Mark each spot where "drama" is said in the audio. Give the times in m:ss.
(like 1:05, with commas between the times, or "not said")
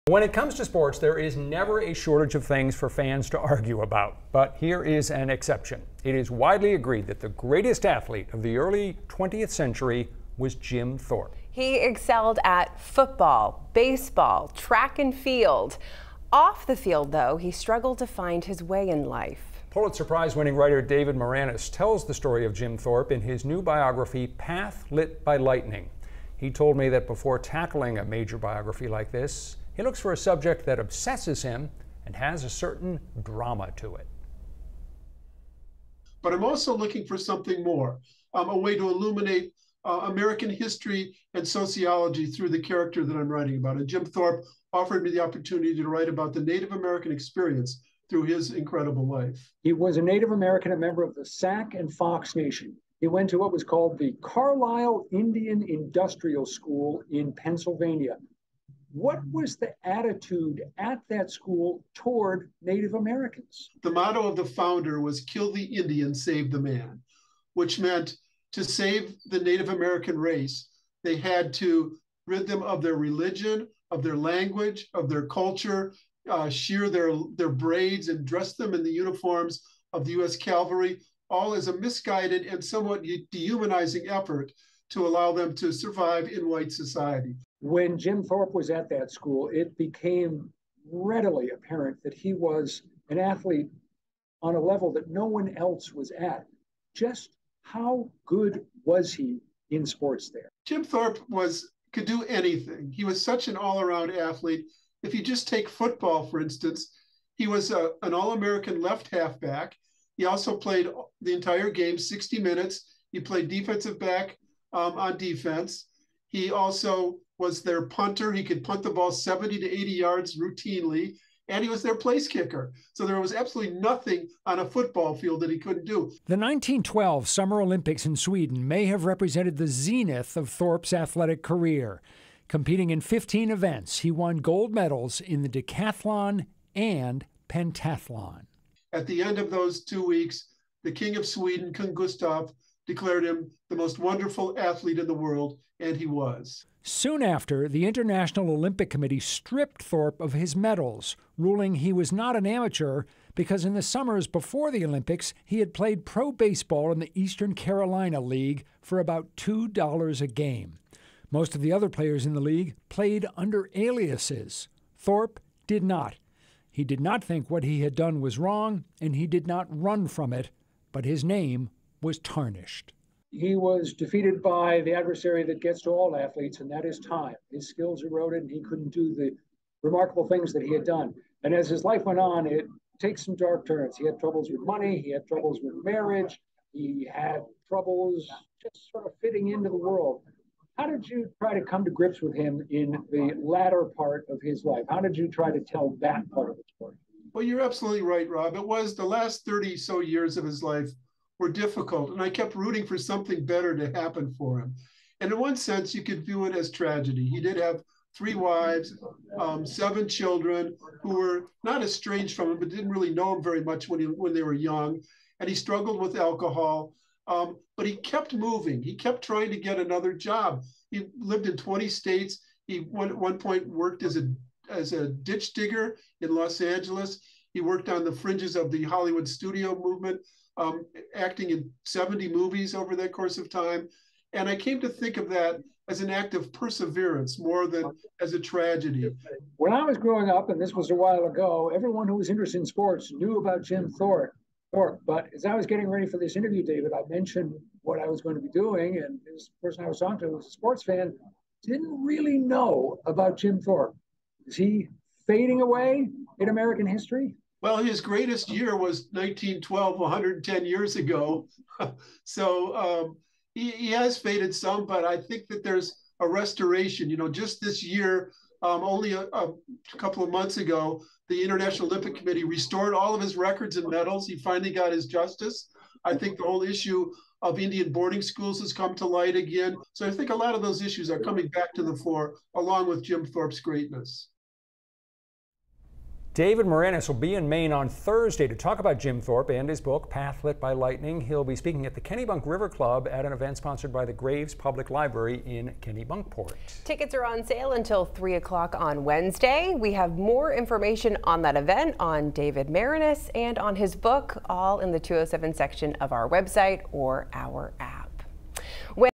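0:33.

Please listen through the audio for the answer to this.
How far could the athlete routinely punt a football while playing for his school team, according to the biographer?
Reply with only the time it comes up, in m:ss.
1:59.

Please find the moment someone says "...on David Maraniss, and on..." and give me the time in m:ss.
5:01.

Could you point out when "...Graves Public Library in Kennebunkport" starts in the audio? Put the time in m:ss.
4:54.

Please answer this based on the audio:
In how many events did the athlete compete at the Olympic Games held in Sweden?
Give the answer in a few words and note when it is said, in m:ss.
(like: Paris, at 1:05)
15, at 2:13.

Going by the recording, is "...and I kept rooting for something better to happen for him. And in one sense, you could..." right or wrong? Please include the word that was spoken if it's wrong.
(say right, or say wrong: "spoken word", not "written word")
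right.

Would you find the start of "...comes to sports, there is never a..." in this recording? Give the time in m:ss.
0:00.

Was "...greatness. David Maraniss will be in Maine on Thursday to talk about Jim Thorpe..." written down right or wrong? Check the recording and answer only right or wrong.
right.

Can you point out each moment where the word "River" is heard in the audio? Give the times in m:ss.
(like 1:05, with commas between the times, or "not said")
4:52.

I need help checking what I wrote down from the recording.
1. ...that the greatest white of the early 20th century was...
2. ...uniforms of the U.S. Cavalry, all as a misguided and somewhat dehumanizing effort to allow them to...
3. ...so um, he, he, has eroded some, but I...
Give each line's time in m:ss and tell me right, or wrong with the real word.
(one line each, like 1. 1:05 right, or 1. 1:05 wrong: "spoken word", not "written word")
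1. 0:07 wrong: "athlete", not "white"
2. 1:18 right
3. 4:22 wrong: "faded", not "eroded".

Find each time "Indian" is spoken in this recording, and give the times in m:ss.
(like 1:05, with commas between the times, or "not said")
0:55, 1:05, 4:37.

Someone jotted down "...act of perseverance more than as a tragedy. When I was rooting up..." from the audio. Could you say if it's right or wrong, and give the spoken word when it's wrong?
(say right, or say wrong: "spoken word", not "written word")
wrong: "growing", not "rooting".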